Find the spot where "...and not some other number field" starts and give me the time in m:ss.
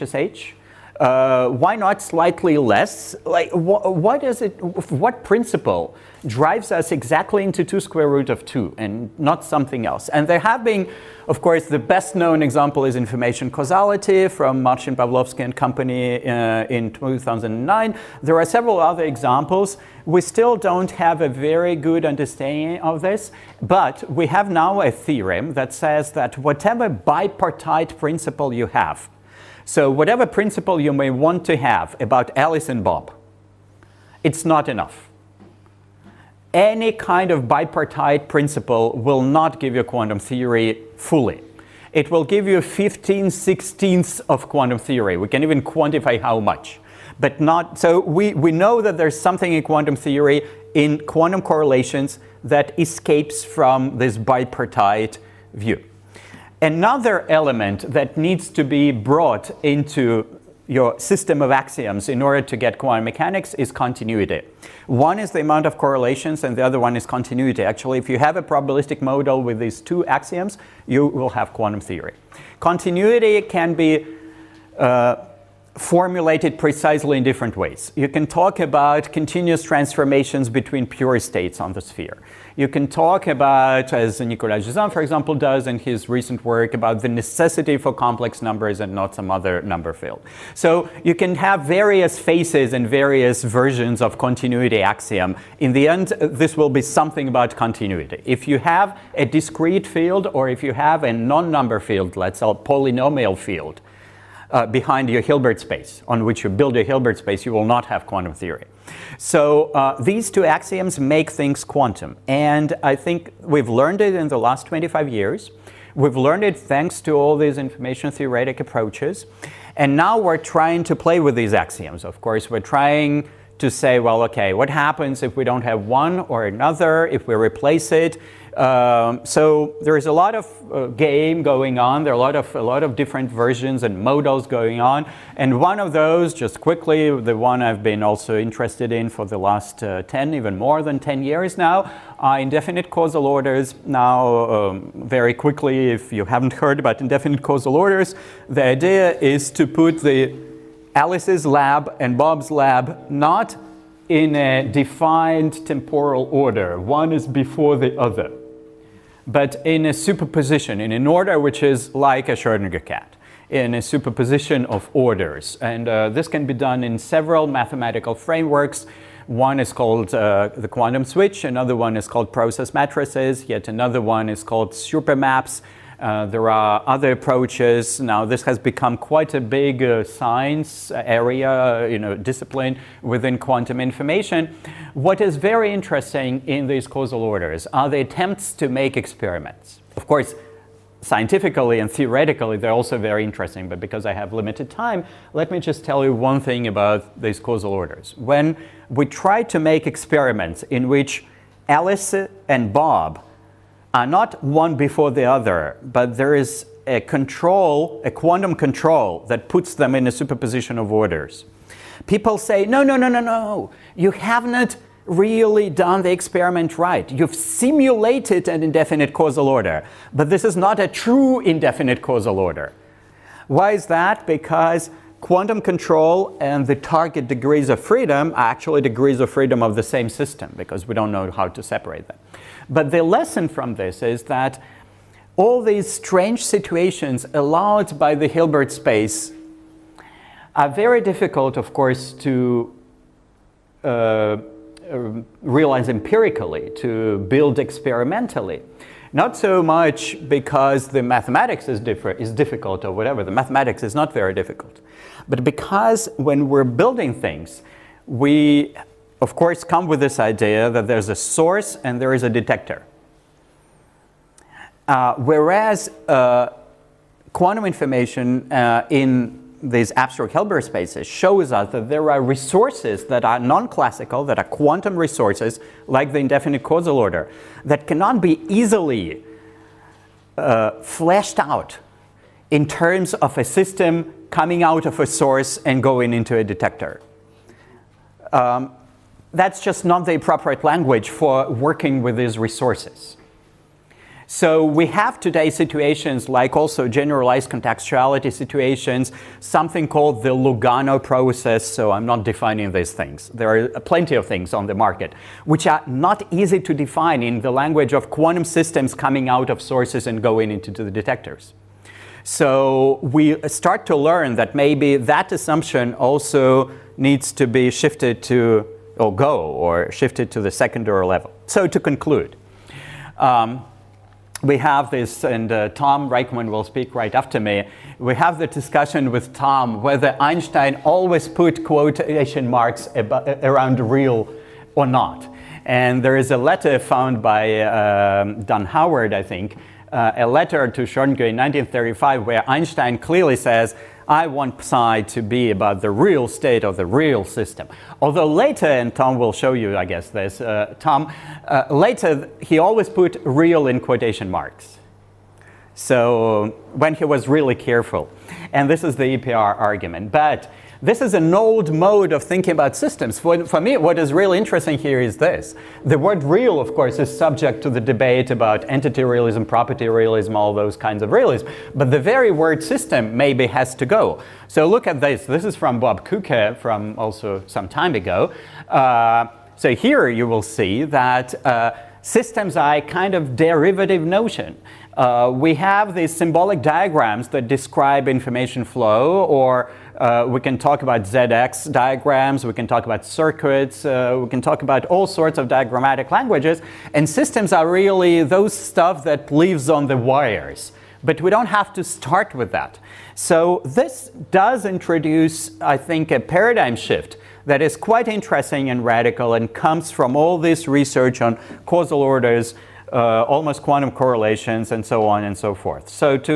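1:28.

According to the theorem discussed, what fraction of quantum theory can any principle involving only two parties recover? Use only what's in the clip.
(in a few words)
15/16.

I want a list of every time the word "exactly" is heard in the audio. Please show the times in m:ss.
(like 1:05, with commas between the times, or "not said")
0:06.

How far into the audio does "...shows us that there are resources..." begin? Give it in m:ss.
4:31.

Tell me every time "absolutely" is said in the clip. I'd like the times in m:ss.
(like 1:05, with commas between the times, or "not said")
not said.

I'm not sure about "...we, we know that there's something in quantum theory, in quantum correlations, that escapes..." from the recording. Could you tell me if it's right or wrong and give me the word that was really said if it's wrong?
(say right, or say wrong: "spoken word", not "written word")
right.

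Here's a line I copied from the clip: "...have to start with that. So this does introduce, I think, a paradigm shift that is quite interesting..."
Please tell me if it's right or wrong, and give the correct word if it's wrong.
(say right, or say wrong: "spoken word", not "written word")
right.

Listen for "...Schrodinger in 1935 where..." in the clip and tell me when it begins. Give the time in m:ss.
5:40.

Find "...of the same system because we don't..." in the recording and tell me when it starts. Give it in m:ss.
3:49.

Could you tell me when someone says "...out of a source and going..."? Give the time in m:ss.
4:44.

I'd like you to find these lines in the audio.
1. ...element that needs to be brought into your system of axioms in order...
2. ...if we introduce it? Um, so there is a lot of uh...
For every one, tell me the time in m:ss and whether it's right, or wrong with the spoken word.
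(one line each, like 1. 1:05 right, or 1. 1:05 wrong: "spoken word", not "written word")
1. 0:57 right
2. 2:07 wrong: "replace", not "introduce".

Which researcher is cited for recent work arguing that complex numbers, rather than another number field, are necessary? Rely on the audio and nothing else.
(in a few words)
Nicolas Gisin.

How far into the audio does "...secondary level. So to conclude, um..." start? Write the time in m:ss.
5:20.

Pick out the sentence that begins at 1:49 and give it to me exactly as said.
So uh, these two axioms make things quantum.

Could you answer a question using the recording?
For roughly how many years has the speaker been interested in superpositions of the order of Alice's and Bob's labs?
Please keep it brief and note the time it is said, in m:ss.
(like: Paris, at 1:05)
more than 10, at 2:20.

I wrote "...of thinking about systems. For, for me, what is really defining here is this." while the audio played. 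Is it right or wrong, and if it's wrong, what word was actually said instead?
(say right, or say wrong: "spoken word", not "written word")
wrong: "interesting", not "defining".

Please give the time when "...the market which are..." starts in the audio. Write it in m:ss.
5:04.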